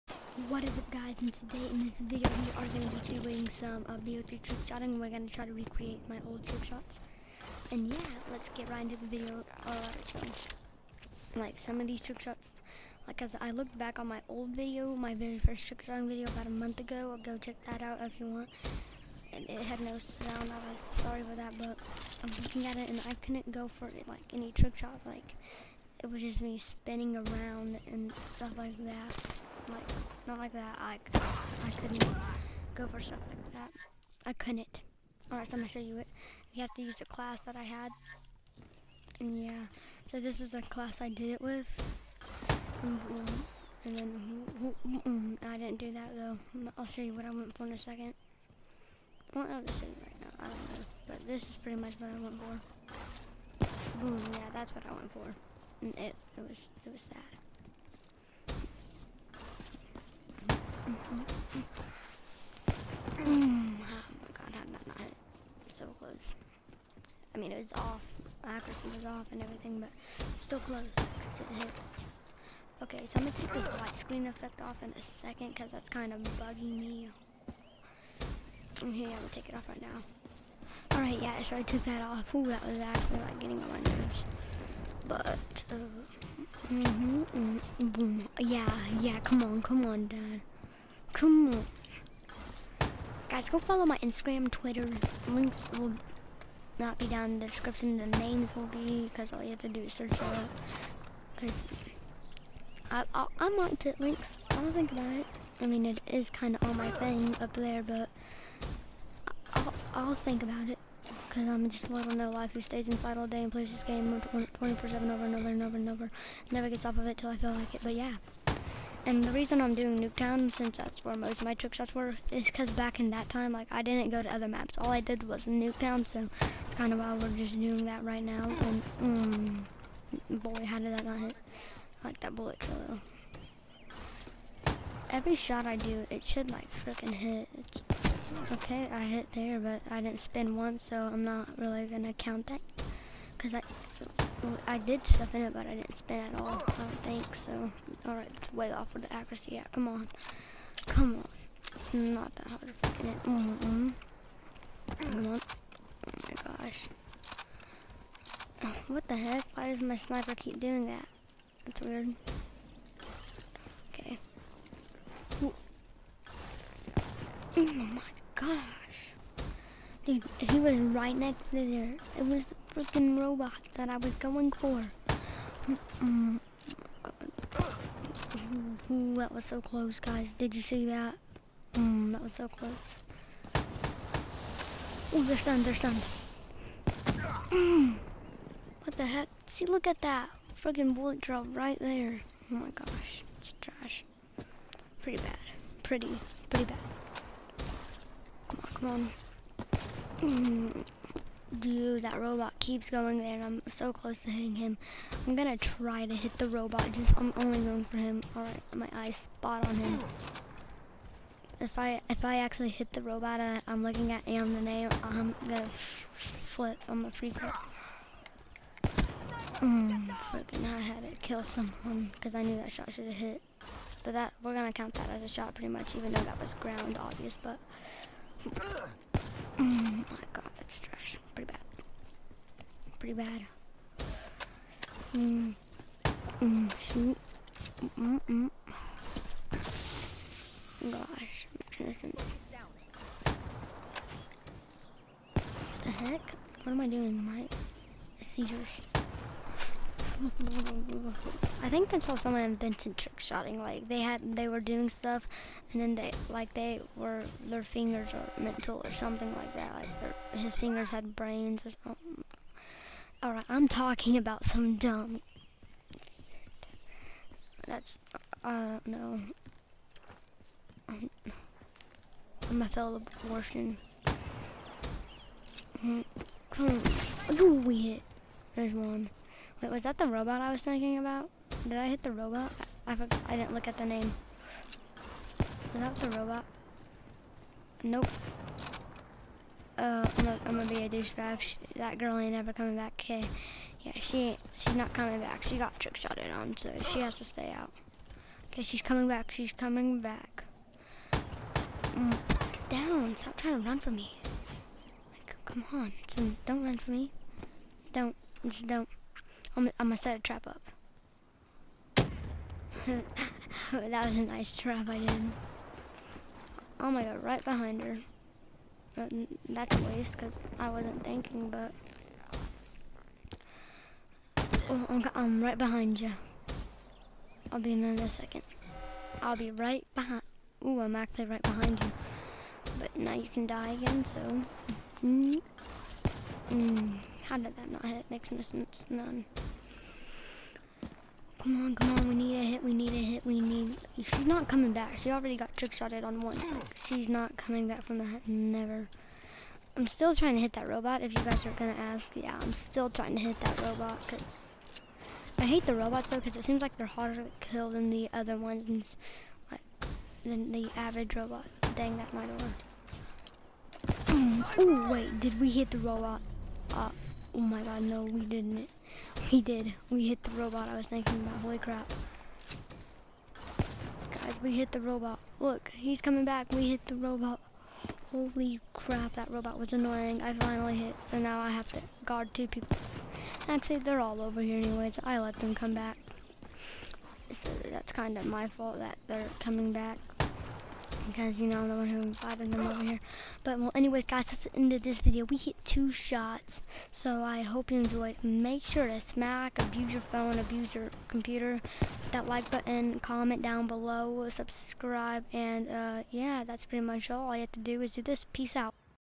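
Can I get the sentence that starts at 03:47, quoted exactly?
But oh my god, that's trash.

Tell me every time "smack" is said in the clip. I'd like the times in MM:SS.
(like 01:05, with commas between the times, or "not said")
06:39.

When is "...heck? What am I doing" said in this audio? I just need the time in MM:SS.
04:05.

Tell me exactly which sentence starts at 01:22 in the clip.
Ooh, that was actually like getting on my nerves.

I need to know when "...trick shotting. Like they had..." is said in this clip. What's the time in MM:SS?
04:12.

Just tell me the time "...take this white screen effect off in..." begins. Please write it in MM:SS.
01:13.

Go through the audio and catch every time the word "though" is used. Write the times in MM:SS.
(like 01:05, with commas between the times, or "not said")
00:46, 03:46, 05:56.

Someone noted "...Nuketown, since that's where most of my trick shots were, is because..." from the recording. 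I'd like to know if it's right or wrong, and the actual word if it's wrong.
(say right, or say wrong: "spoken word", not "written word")
right.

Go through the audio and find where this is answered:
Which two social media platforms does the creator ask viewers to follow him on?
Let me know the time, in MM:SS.
01:33.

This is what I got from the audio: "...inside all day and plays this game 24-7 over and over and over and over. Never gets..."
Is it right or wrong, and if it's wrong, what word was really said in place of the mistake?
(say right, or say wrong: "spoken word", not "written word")
right.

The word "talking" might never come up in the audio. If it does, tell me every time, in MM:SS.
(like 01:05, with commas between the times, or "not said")
04:23.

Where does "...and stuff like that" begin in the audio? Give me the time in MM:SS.
00:27.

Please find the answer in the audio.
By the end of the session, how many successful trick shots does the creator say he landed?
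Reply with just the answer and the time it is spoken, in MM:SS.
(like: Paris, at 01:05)
2, at 06:35.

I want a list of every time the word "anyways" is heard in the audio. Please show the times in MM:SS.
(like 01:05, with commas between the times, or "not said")
06:24, 06:33.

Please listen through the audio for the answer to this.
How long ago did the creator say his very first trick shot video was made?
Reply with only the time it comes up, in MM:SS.
00:16.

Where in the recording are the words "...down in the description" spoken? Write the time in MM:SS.
01:37.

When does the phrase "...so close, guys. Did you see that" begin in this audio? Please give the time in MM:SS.
02:59.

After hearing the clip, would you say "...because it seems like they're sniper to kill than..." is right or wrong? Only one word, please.
wrong.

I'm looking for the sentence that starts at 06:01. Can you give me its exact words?
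Dang, that might have mm, Oh wait, did we hit the robot?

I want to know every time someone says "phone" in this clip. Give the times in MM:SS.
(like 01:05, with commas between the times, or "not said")
06:40.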